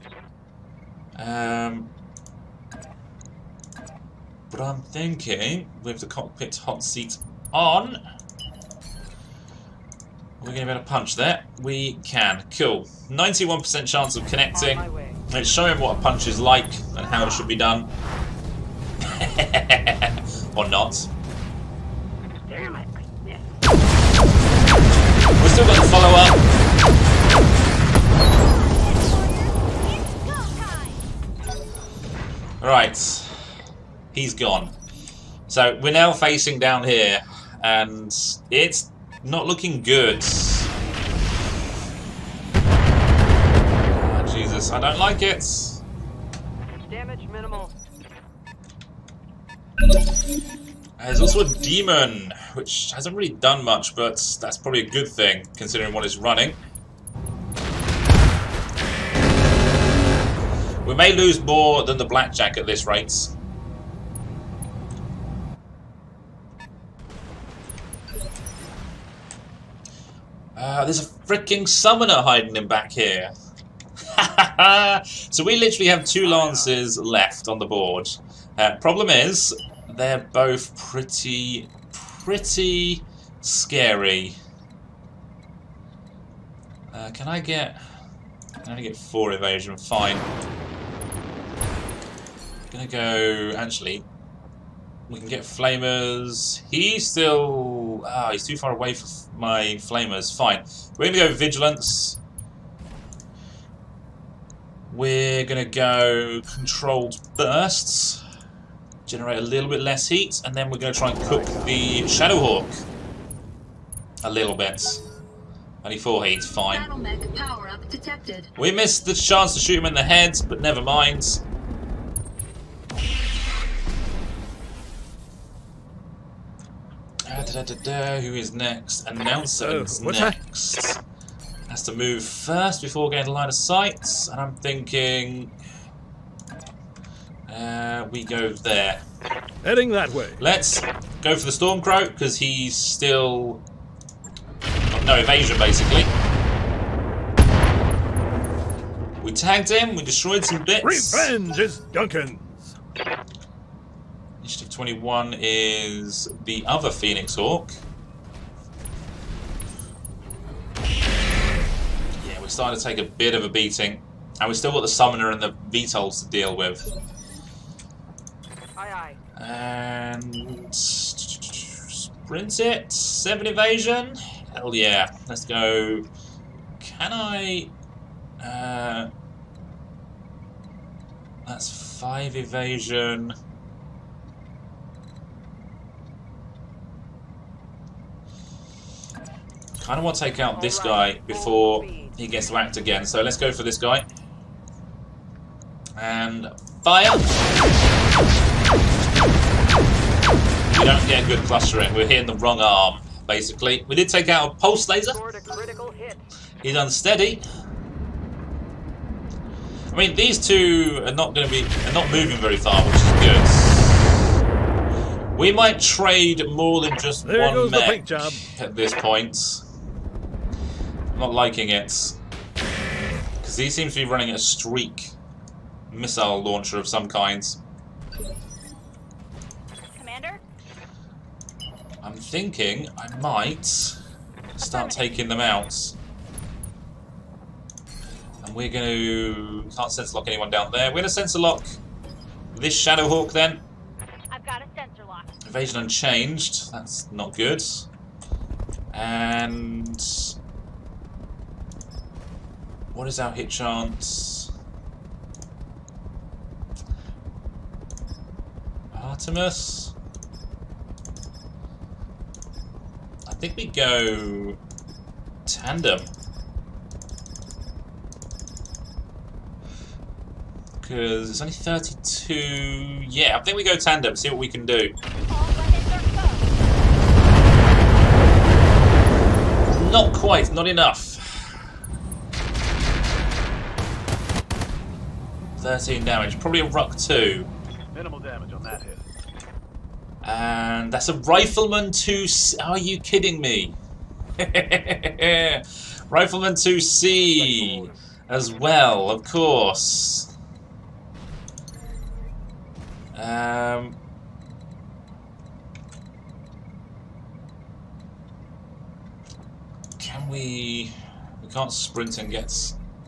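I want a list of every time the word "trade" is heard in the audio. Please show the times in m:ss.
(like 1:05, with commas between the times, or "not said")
3:35.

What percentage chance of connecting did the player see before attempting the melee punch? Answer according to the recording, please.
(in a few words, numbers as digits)
91%.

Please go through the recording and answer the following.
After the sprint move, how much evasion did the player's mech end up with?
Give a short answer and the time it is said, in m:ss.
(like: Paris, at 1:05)
7, at 2:52.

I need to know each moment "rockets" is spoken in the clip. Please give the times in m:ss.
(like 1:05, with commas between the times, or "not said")
not said.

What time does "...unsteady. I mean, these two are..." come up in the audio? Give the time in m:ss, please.
3:26.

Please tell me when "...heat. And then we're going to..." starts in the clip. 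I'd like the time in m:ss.
1:50.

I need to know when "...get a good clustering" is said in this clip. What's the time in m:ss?
3:21.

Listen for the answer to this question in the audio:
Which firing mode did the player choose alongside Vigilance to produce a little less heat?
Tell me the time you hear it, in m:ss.
1:46.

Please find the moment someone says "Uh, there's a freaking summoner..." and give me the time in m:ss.
1:10.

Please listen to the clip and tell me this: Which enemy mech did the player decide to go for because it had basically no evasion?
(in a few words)
Stormcrow.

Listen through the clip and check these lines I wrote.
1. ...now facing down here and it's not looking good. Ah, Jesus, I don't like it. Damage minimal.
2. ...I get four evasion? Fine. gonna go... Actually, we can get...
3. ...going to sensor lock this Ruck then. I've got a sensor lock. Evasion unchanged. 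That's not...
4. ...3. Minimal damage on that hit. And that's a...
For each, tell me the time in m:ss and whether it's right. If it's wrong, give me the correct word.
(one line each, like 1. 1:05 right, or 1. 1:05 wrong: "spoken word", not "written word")
1. 0:35 right
2. 1:28 right
3. 4:00 wrong: "Shadowhawk", not "Ruck"
4. 4:46 wrong: "2", not "3".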